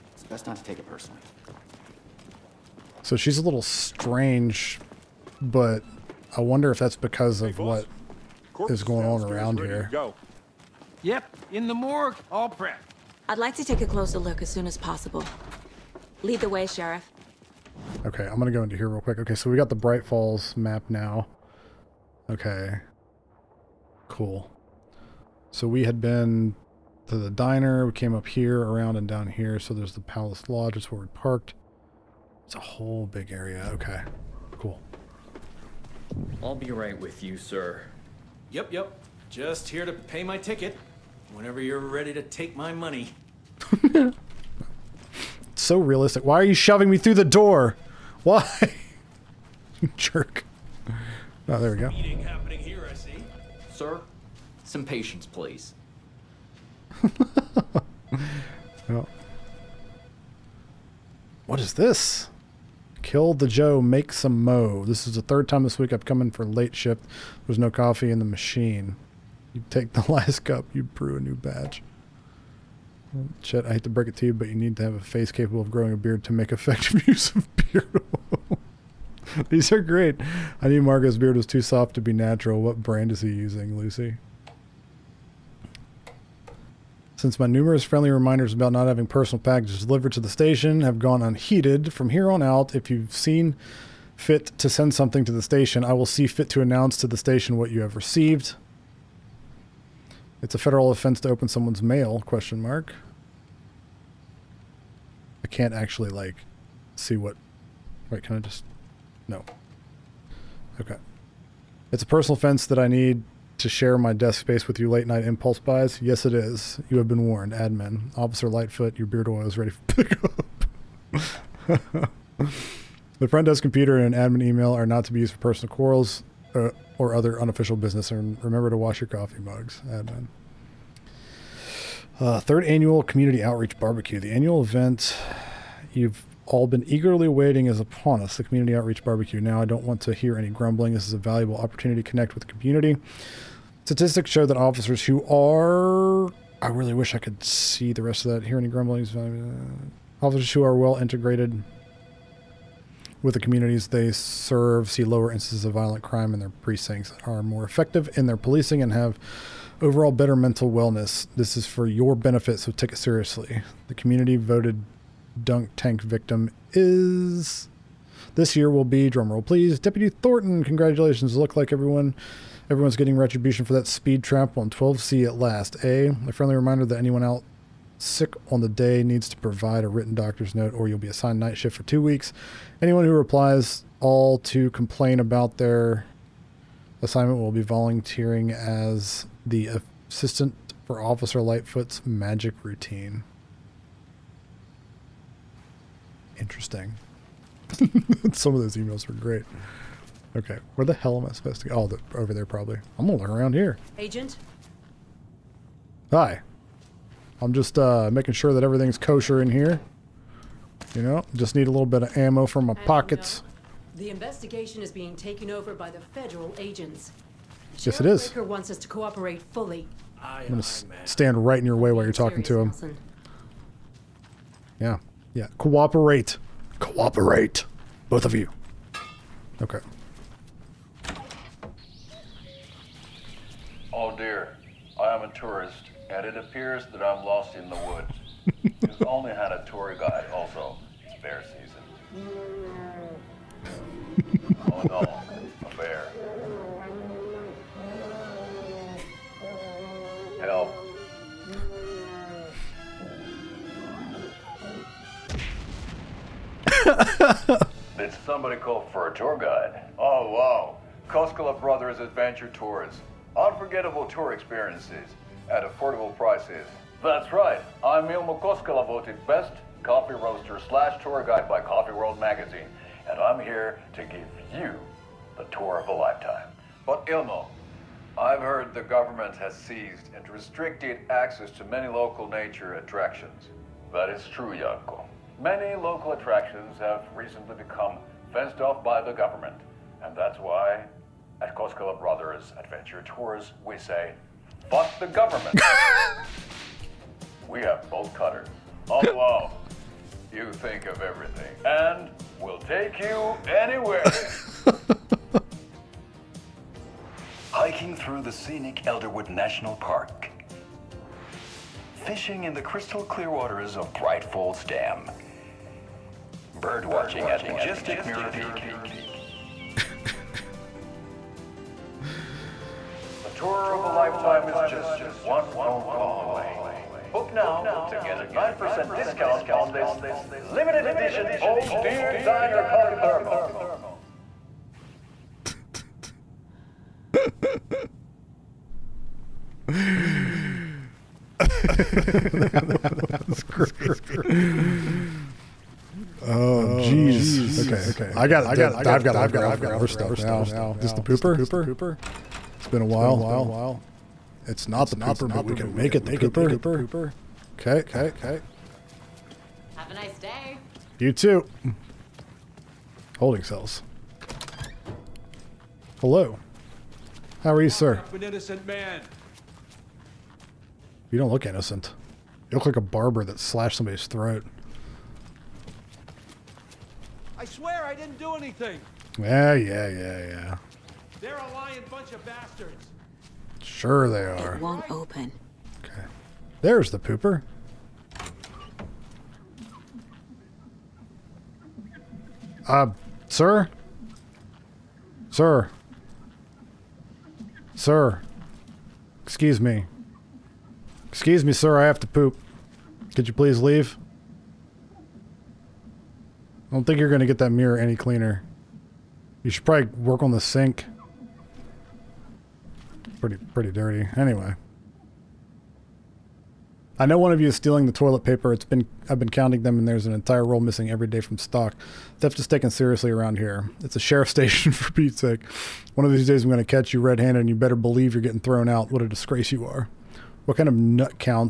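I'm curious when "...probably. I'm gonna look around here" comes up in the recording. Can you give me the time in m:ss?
3:22.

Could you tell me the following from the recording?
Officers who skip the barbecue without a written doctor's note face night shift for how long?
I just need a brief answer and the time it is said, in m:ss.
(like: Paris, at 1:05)
2 weeks, at 3:01.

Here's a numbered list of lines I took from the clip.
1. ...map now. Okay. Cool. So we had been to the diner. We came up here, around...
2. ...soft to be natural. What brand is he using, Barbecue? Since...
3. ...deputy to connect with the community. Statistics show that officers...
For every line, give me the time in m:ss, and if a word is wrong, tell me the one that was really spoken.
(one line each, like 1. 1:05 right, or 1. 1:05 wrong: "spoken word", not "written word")
1. 0:20 right
2. 1:21 wrong: "Lucy", not "Barbecue"
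3. 2:21 wrong: "opportunity", not "deputy".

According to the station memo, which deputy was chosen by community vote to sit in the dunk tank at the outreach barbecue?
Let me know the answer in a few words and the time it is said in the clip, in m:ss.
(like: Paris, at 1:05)
Deputy Thornton, at 2:49.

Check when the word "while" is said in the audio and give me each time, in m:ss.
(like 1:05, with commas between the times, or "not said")
3:41, 5:52.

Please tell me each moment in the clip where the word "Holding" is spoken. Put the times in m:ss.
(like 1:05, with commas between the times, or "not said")
6:03.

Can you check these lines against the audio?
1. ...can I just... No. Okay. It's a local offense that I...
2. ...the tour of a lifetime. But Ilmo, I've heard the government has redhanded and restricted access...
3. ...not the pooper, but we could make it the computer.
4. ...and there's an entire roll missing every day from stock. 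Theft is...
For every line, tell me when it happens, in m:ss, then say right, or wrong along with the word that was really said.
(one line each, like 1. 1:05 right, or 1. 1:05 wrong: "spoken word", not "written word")
1. 1:48 wrong: "personal", not "local"
2. 4:35 wrong: "seized", not "redhanded"
3. 5:54 wrong: "pooper", not "computer"
4. 6:59 right.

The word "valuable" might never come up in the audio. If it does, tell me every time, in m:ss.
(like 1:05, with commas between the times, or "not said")
2:21.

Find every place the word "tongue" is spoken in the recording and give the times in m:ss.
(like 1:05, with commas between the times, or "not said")
not said.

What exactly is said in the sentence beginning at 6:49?
You should probably work on the sink pretty pretty dirty.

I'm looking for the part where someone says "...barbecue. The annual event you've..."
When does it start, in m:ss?
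2:13.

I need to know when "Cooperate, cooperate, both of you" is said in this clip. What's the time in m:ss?
3:45.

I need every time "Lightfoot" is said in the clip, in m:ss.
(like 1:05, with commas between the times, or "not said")
1:58, 3:11.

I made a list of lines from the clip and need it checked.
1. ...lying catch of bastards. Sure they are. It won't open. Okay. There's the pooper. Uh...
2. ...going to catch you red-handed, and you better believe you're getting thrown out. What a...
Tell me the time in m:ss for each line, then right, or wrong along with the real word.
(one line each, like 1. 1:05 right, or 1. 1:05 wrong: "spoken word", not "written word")
1. 6:21 wrong: "bunch", not "catch"
2. 7:06 right.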